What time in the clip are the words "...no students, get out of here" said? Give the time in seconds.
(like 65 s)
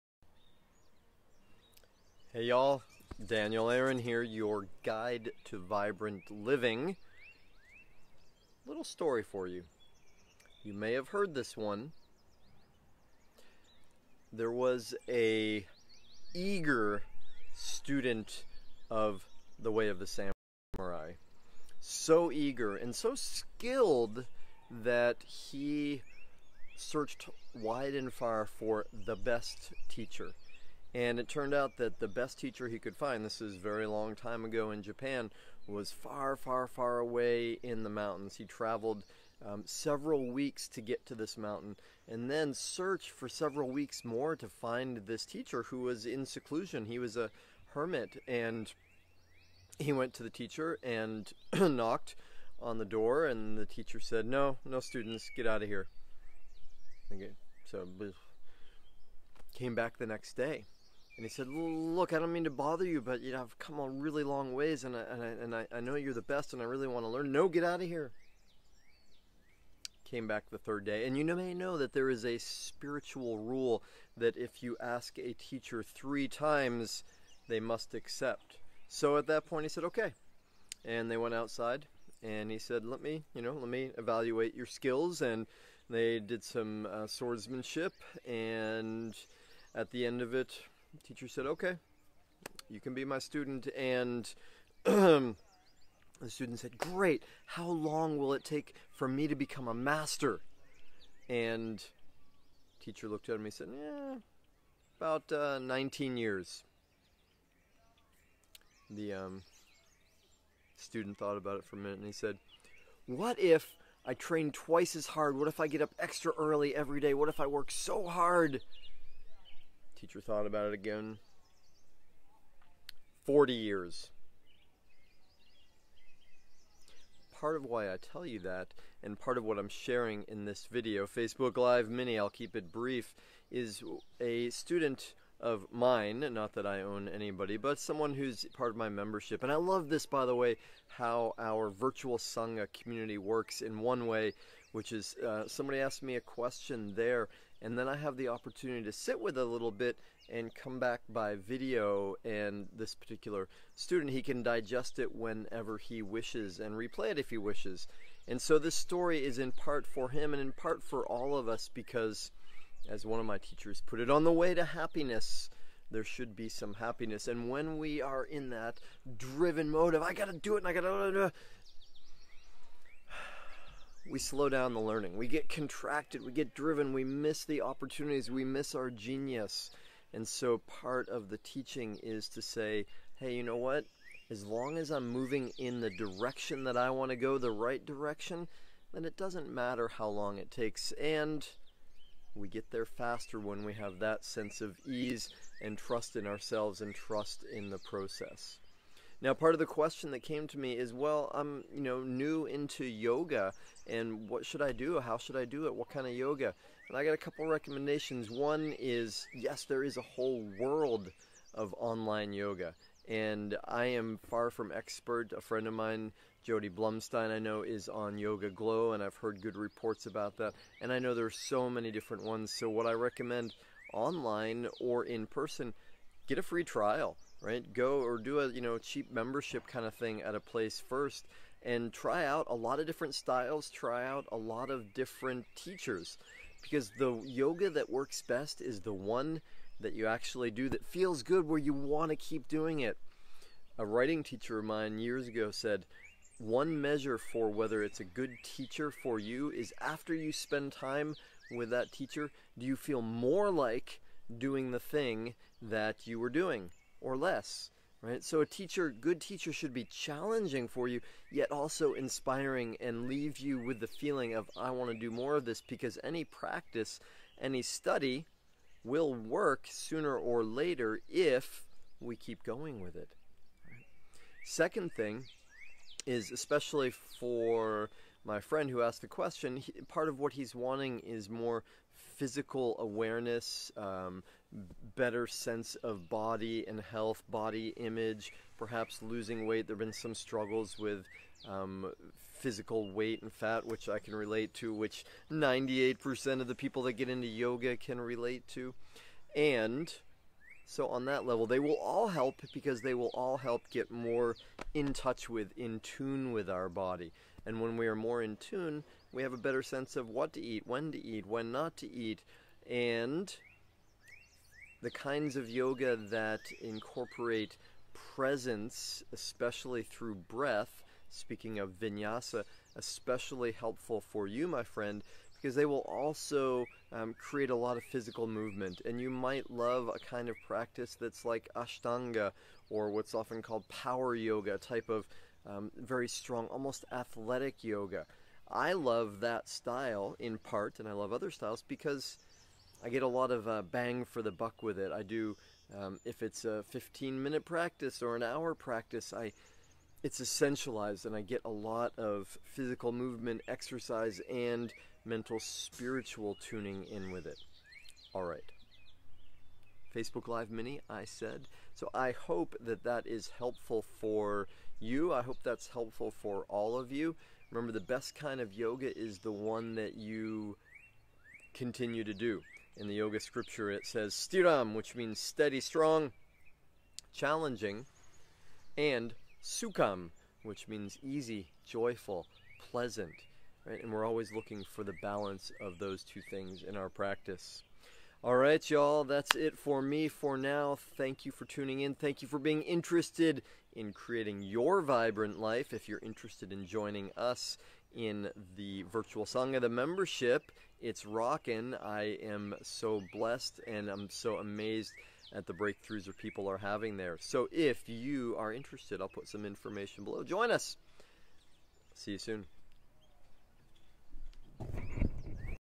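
54 s.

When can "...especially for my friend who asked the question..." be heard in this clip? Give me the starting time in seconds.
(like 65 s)
276 s.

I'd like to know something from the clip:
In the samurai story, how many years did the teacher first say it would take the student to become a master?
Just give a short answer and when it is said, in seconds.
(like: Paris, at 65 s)
19, at 105 s.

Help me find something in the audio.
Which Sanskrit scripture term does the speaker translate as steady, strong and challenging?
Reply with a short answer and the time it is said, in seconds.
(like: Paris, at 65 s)
stiram, at 374 s.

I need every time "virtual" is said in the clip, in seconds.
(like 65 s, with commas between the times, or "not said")
141 s, 398 s.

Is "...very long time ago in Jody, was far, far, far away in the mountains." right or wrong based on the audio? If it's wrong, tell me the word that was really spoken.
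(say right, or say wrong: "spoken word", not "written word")
wrong: "Japan", not "Jody".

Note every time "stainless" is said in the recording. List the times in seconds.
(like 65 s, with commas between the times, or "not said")
not said.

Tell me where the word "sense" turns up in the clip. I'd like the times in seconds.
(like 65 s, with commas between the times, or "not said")
194 s, 285 s, 309 s.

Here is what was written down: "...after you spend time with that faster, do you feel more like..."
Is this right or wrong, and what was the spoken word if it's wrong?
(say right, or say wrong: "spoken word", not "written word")
wrong: "teacher", not "faster".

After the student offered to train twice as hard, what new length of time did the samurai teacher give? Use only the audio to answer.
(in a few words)
40 years.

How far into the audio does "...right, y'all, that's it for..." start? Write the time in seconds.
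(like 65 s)
388 s.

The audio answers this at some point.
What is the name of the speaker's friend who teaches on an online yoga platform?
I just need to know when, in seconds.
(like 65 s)
216 s.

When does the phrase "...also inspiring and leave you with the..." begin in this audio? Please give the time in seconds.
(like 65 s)
261 s.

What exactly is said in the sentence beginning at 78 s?
So at that point, he said, okay.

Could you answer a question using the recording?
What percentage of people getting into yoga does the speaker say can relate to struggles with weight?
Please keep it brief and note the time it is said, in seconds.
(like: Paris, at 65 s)
98%, at 295 s.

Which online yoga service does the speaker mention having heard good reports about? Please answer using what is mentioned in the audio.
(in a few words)
YogaGlo.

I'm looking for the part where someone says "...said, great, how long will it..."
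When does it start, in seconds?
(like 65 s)
96 s.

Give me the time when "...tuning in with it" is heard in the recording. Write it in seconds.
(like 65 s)
356 s.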